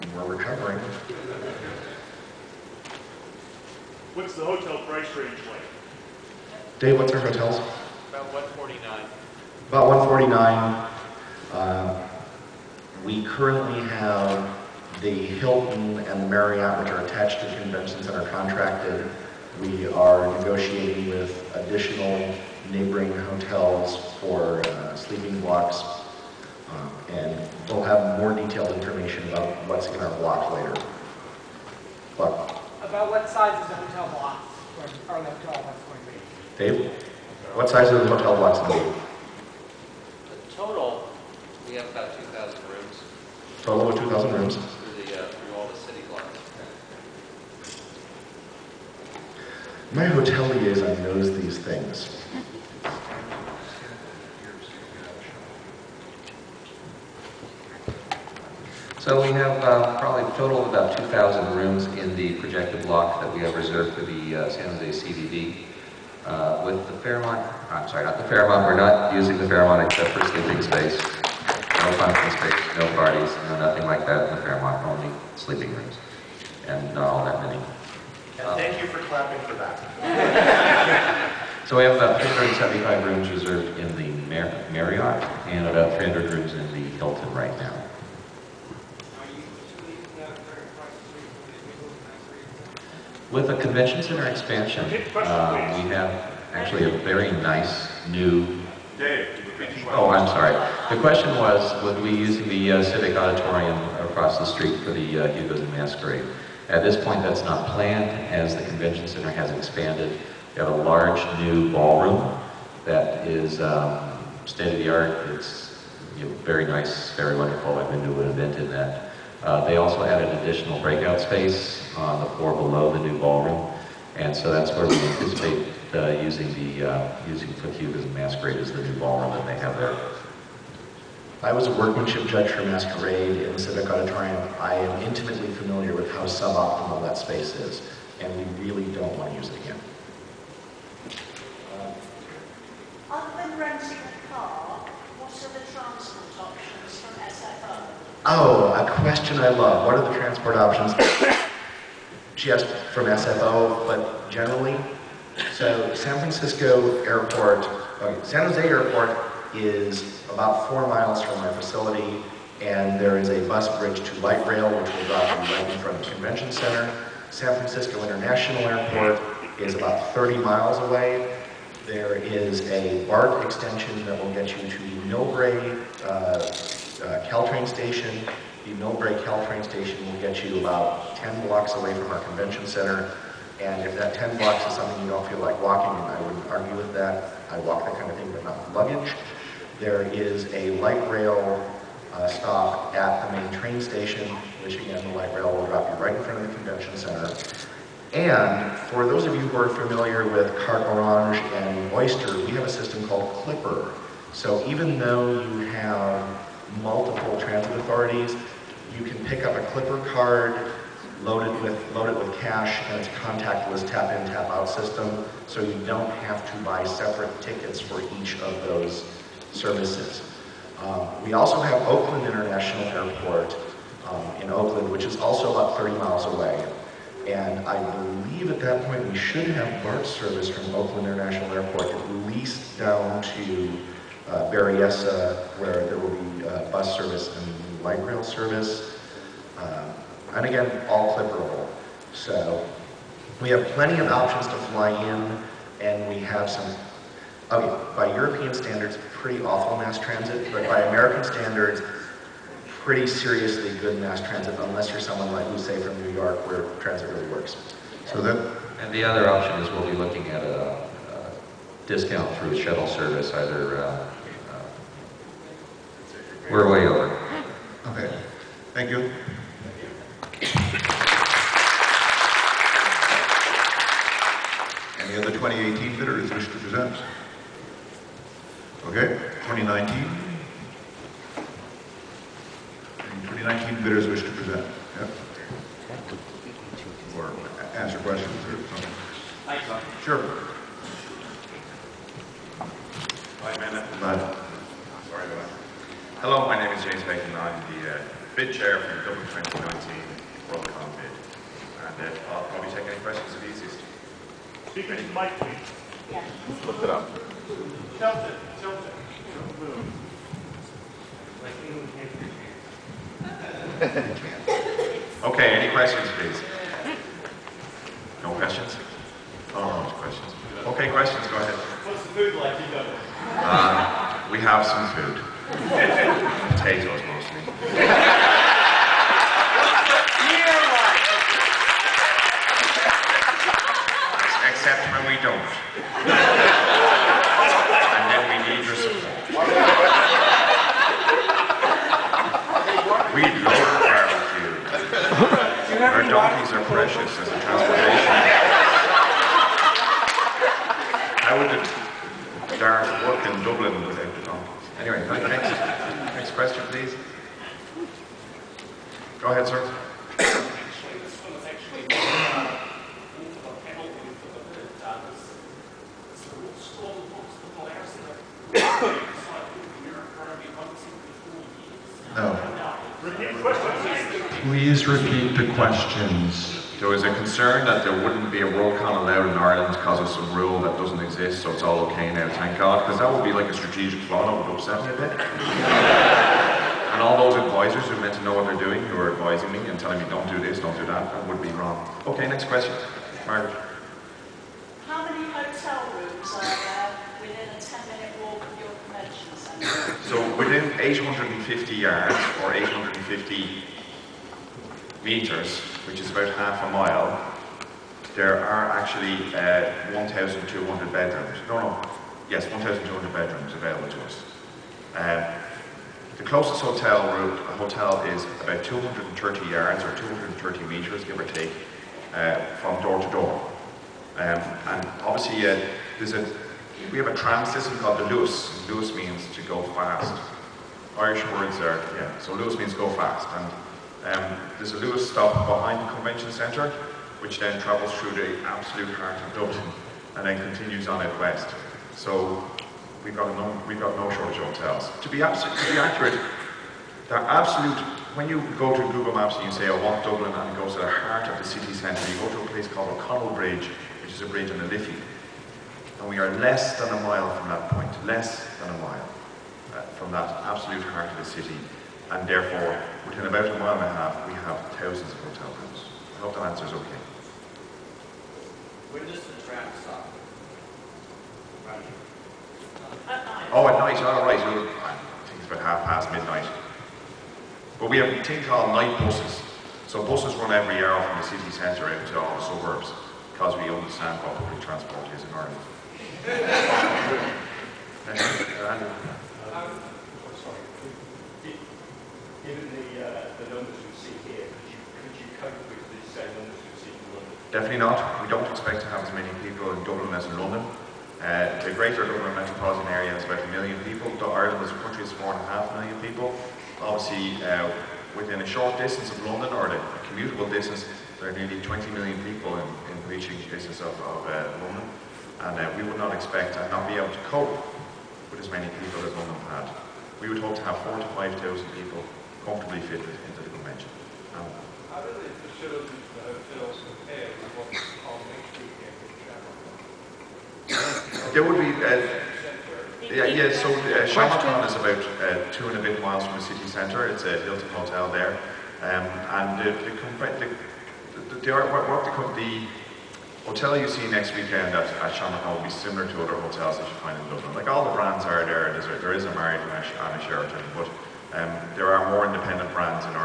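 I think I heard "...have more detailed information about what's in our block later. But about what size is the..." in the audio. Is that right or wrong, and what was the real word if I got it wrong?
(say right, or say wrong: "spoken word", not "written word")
right.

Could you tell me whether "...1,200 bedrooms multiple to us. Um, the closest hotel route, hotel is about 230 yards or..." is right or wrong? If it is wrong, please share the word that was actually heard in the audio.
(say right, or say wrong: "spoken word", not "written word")
wrong: "available", not "multiple".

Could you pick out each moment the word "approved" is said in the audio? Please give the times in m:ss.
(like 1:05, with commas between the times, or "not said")
not said.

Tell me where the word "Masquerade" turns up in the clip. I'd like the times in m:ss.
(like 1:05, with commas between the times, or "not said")
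1:45, 2:08, 2:12.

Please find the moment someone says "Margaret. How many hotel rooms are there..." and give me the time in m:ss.
6:33.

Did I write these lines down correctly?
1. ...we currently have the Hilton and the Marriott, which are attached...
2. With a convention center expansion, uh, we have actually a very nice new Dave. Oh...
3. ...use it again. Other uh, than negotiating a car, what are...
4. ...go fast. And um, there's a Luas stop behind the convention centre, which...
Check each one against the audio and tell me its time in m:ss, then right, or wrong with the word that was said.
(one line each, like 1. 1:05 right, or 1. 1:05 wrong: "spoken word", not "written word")
1. 0:13 right
2. 1:33 right
3. 2:19 wrong: "renting", not "negotiating"
4. 7:12 right.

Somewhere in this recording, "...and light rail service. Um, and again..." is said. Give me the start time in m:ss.
3:57.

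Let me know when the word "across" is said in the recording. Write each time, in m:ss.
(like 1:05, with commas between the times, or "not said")
1:44.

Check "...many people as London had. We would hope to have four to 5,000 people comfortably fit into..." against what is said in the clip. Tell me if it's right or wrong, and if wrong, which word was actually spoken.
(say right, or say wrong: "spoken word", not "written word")
right.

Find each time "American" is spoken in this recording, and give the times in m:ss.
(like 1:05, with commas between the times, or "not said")
4:10.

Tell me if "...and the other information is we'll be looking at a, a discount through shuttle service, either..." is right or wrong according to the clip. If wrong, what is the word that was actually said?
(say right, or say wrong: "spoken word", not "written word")
wrong: "option", not "information".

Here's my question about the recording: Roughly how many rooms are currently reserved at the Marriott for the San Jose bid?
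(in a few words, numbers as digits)
375.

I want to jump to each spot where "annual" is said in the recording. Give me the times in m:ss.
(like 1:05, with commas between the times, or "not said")
not said.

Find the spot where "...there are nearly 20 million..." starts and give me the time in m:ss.
8:31.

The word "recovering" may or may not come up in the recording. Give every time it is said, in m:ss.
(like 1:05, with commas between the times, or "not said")
0:00.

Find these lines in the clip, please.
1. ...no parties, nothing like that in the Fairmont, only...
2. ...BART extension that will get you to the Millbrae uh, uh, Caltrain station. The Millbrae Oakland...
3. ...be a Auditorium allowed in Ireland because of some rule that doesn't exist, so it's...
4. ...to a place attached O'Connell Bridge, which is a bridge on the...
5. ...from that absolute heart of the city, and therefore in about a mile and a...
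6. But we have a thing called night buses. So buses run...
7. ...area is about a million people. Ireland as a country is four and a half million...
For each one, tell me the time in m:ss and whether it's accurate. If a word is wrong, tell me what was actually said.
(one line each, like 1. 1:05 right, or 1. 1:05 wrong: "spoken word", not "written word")
1. 1:12 right
2. 2:53 wrong: "Caltrain", not "Oakland"
3. 6:18 wrong: "Worldcon", not "Auditorium"
4. 7:32 wrong: "called", not "attached"
5. 7:39 right
6. 7:57 right
7. 8:22 right.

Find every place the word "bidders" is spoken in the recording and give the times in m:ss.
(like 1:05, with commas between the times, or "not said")
4:35, 4:43.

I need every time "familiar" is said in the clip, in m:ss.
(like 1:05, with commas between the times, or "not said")
2:15, 3:19.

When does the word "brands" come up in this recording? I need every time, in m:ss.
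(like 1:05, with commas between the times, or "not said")
9:07, 9:12.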